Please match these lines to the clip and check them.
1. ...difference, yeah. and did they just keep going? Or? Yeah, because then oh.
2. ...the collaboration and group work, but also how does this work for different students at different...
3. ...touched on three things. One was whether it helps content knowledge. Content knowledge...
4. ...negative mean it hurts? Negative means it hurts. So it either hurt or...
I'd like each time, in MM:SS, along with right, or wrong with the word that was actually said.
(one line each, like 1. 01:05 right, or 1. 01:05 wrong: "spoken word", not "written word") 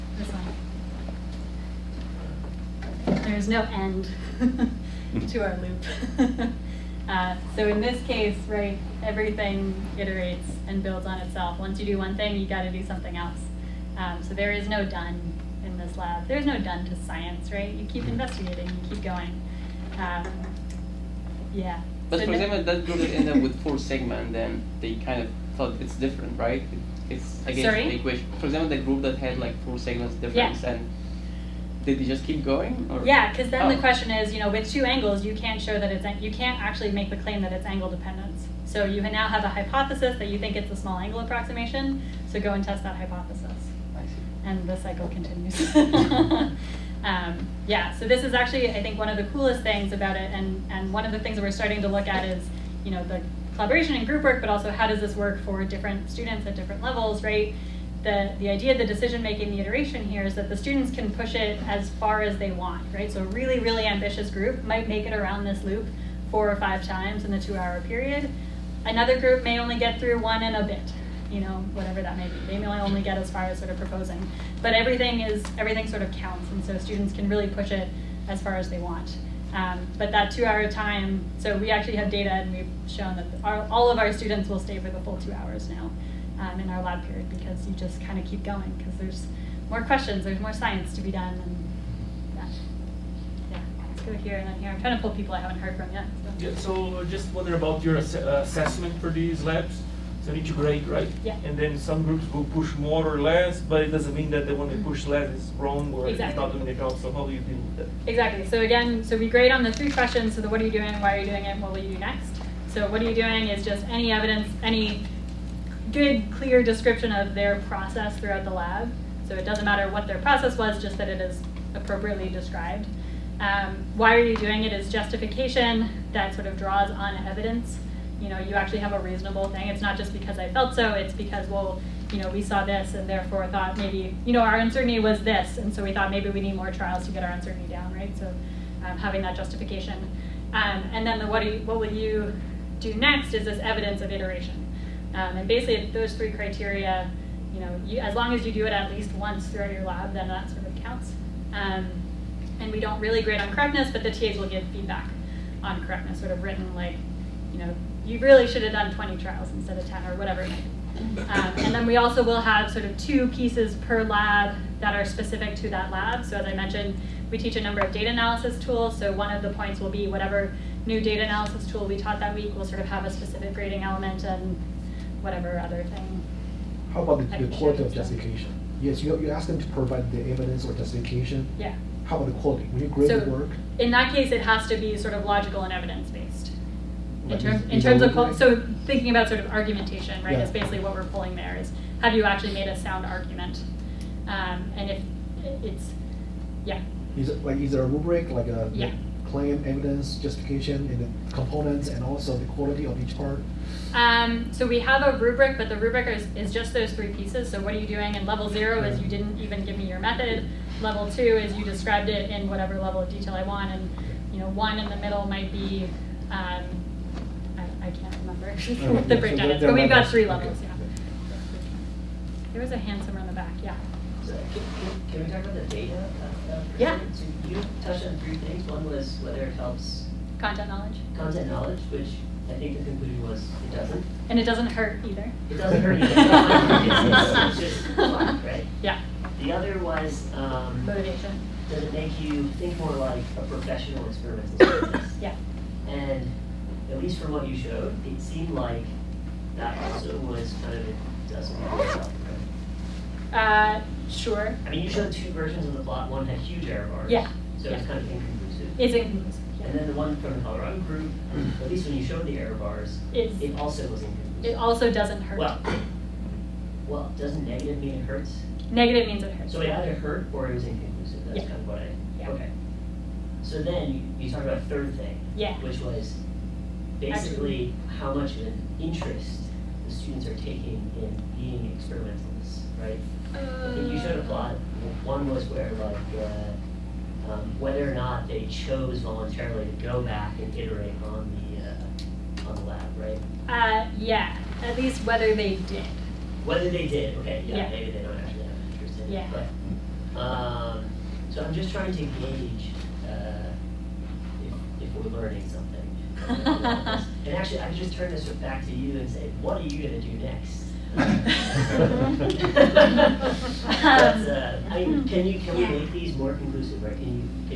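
1. 00:30 right
2. 00:53 right
3. 03:47 right
4. 04:27 right.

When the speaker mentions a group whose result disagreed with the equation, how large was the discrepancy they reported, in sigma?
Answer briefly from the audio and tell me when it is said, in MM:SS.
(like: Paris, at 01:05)
4 sigma, at 00:23.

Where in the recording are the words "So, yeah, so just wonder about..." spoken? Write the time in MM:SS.
01:36.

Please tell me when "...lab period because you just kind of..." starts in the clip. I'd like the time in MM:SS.
01:26.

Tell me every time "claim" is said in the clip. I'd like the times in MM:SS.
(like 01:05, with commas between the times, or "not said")
00:37, 03:19.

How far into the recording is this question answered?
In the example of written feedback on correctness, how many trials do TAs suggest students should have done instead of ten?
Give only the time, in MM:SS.
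02:38.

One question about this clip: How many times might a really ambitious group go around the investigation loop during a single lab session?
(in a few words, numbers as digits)
4 or 5 times.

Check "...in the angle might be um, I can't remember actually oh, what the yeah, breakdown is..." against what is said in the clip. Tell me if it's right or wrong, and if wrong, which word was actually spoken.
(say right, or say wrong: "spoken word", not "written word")
wrong: "middle", not "angle".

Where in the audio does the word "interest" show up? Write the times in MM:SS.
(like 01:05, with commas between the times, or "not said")
04:38, 04:58.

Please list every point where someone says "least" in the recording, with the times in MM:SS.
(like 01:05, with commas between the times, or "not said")
02:28, 04:07, 04:21, 04:54.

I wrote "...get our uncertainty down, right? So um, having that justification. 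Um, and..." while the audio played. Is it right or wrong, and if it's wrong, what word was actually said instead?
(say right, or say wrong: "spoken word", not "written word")
right.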